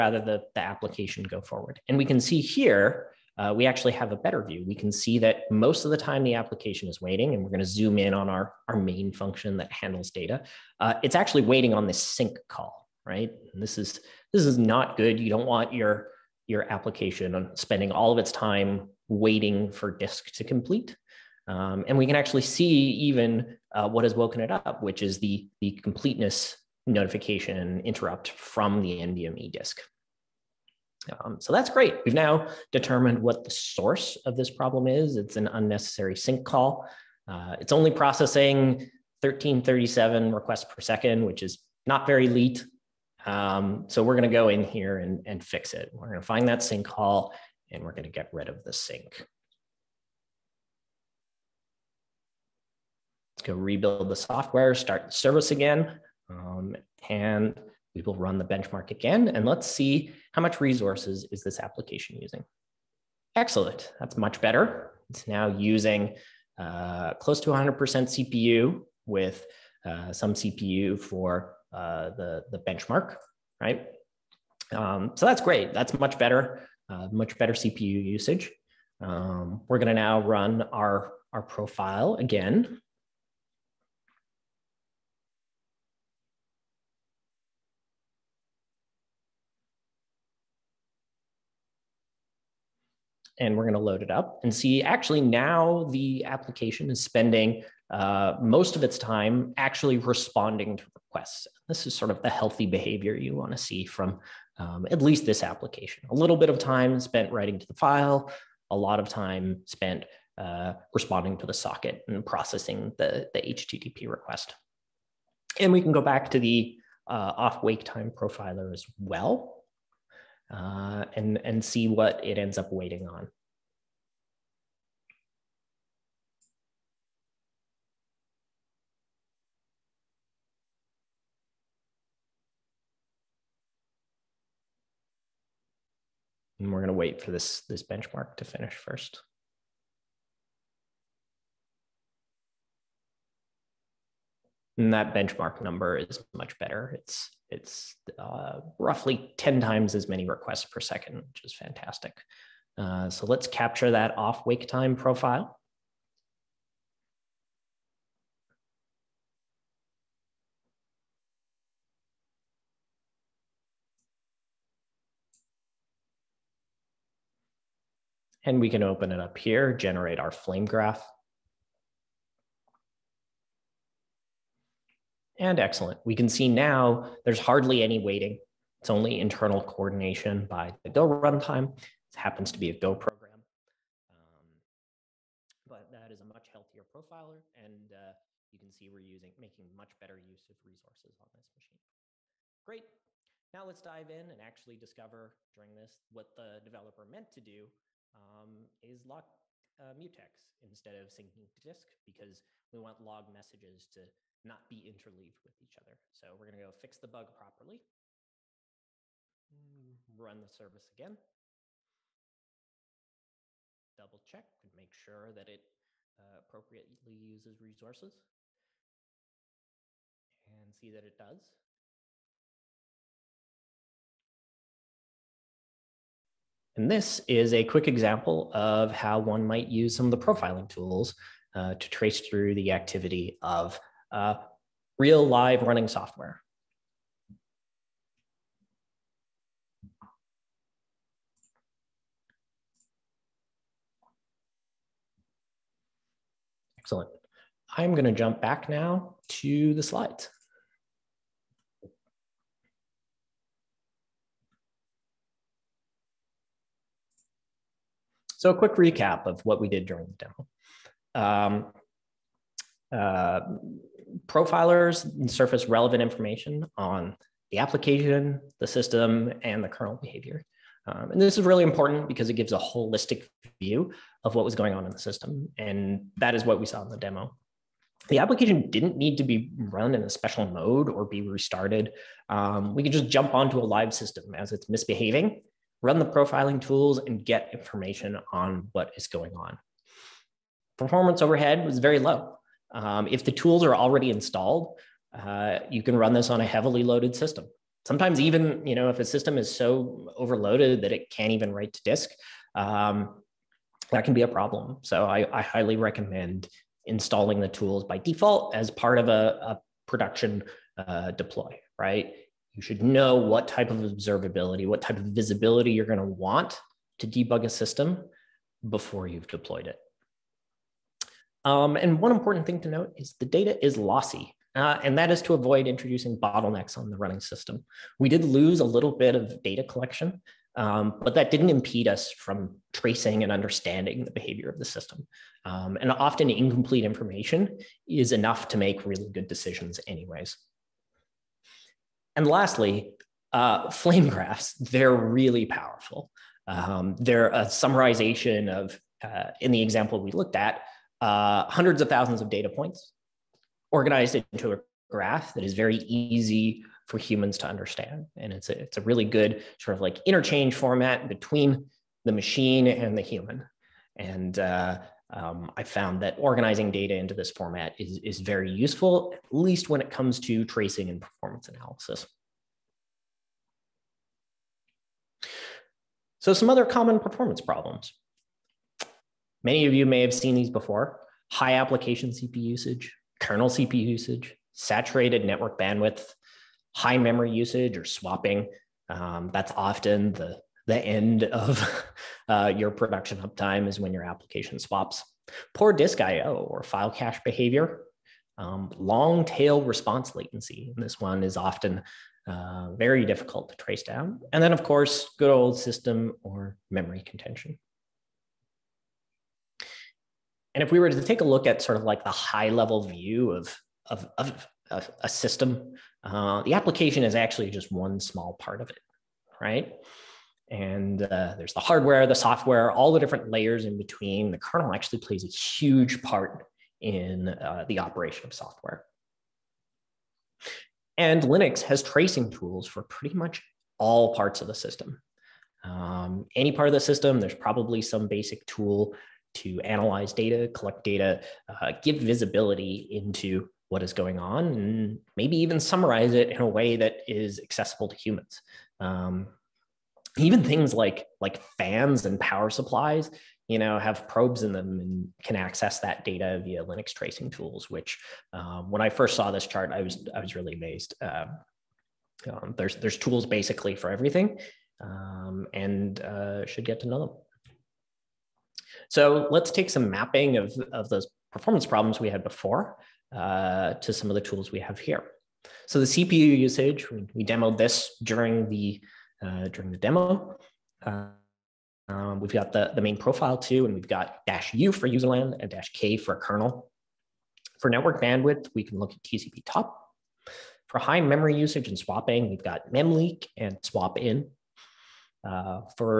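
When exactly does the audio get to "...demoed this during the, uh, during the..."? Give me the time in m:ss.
7:57.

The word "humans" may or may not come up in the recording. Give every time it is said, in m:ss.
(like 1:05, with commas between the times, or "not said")
5:56, 6:03, 7:27.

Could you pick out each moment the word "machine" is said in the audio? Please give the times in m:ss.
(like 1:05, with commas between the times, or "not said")
3:11, 6:02.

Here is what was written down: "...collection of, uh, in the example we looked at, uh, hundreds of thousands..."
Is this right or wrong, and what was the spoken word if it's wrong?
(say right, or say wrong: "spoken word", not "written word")
wrong: "summarization", not "collection".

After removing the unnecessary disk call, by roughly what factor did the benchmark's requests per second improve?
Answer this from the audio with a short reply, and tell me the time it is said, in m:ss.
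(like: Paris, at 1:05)
10 times, at 2:29.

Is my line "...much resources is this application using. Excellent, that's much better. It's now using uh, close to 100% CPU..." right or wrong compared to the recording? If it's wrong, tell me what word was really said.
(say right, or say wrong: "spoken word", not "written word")
right.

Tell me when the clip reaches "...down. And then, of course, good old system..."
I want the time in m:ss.
6:43.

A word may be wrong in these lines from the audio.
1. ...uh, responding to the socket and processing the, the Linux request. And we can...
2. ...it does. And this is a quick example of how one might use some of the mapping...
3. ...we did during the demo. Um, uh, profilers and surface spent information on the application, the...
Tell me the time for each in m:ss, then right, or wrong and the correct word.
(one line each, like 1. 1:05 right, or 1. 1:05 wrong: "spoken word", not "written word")
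1. 1:50 wrong: "HTTP", not "Linux"
2. 3:41 wrong: "profiling", not "mapping"
3. 4:19 wrong: "relevant", not "spent".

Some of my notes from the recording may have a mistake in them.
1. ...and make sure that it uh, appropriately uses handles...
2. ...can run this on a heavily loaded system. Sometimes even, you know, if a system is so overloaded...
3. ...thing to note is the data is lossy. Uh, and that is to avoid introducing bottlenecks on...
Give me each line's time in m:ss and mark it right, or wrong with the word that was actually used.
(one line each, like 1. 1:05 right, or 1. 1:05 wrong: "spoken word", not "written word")
1. 3:34 wrong: "resources", not "handles"
2. 4:55 right
3. 5:22 right.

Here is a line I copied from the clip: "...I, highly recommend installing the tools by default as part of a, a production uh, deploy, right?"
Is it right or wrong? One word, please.
right.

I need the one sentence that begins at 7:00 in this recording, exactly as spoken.
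And uh, there's the hardware, the software, all the different layers in between.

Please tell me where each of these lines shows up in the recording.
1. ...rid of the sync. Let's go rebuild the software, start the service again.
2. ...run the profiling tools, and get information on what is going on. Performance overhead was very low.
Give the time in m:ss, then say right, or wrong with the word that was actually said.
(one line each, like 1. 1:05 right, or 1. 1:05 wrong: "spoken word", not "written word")
1. 0:48 right
2. 4:45 right.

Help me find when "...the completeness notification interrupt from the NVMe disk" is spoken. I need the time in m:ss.
0:25.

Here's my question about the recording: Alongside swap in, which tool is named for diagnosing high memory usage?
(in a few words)
memleak.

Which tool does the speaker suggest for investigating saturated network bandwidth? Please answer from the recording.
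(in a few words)
TCP top.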